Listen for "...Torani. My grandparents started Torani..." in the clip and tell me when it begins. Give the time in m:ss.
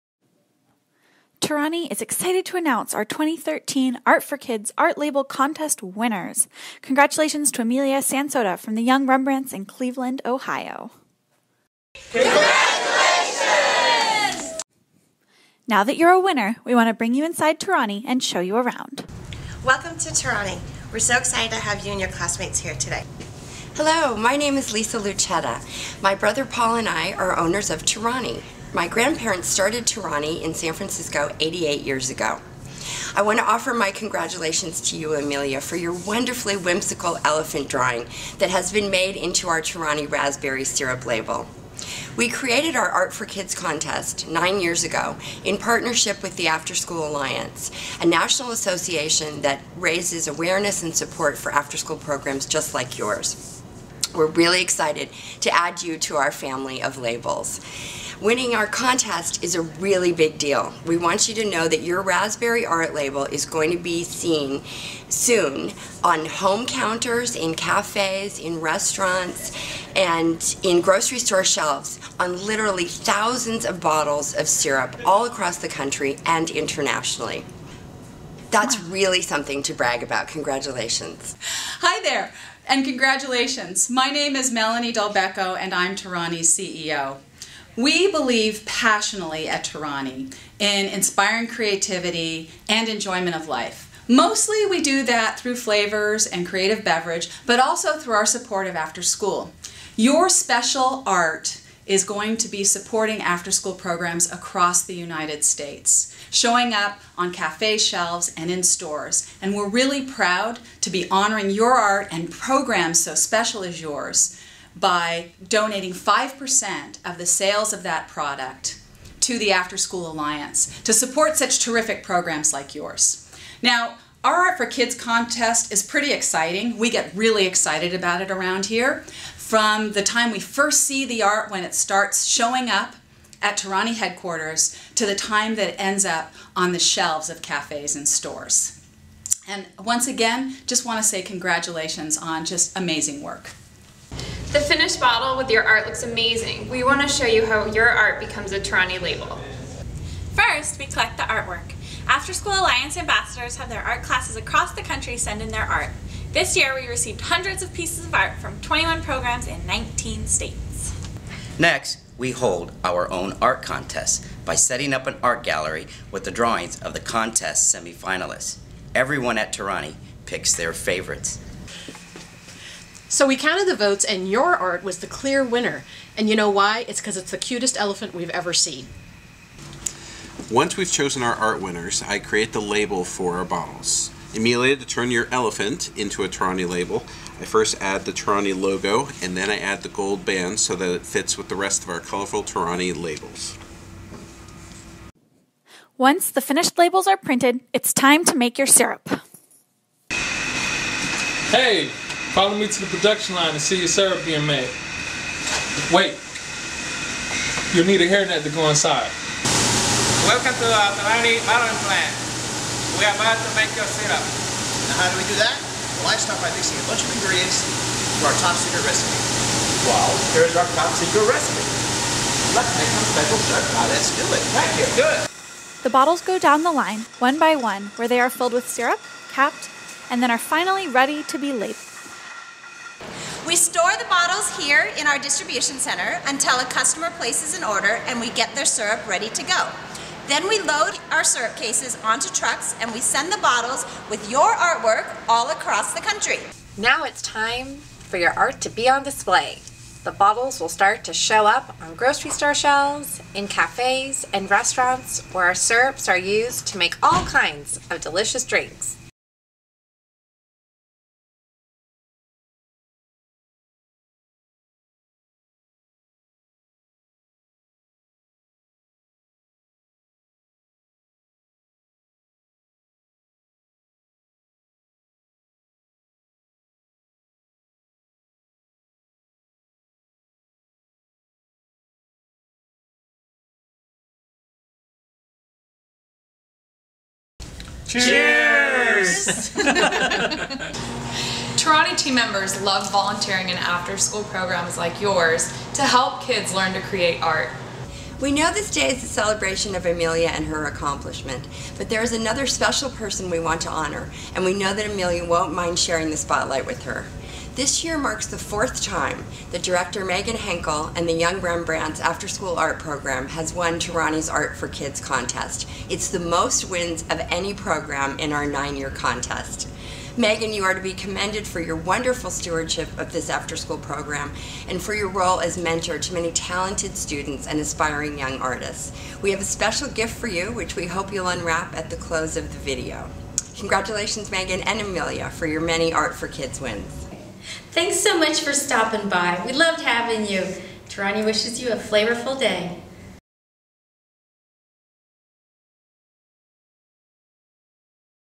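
0:27.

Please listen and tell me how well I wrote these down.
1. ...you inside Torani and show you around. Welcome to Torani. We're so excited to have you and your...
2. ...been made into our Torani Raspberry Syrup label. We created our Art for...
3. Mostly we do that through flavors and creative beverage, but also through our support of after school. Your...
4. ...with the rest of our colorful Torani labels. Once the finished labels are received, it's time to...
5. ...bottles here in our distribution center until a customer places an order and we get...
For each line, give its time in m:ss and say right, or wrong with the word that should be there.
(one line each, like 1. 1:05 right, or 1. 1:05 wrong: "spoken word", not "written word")
1. 0:17 right
2. 0:38 right
3. 1:34 right
4. 3:11 wrong: "printed", not "received"
5. 3:54 right.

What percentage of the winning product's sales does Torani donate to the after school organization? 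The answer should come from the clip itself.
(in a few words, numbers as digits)
5%.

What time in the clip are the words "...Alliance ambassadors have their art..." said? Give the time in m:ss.
2:32.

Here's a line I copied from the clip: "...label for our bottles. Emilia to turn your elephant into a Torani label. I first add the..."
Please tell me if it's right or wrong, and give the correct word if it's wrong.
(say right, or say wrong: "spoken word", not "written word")
right.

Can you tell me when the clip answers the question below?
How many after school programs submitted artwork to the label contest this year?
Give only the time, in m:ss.
2:38.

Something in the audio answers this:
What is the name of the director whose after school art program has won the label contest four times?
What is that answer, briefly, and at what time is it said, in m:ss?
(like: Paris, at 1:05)
Megan Henkel, at 5:10.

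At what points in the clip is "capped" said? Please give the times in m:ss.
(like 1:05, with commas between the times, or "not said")
3:49.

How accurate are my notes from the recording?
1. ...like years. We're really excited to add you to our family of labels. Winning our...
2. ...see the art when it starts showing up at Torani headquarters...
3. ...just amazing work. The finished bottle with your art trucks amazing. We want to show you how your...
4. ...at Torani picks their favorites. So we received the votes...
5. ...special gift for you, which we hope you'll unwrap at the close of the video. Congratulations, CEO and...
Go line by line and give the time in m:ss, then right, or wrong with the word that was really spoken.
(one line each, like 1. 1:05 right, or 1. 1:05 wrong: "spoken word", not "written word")
1. 0:52 wrong: "yours", not "years"
2. 2:10 right
3. 2:22 wrong: "looks", not "trucks"
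4. 2:49 wrong: "counted", not "received"
5. 5:29 wrong: "Megan", not "CEO".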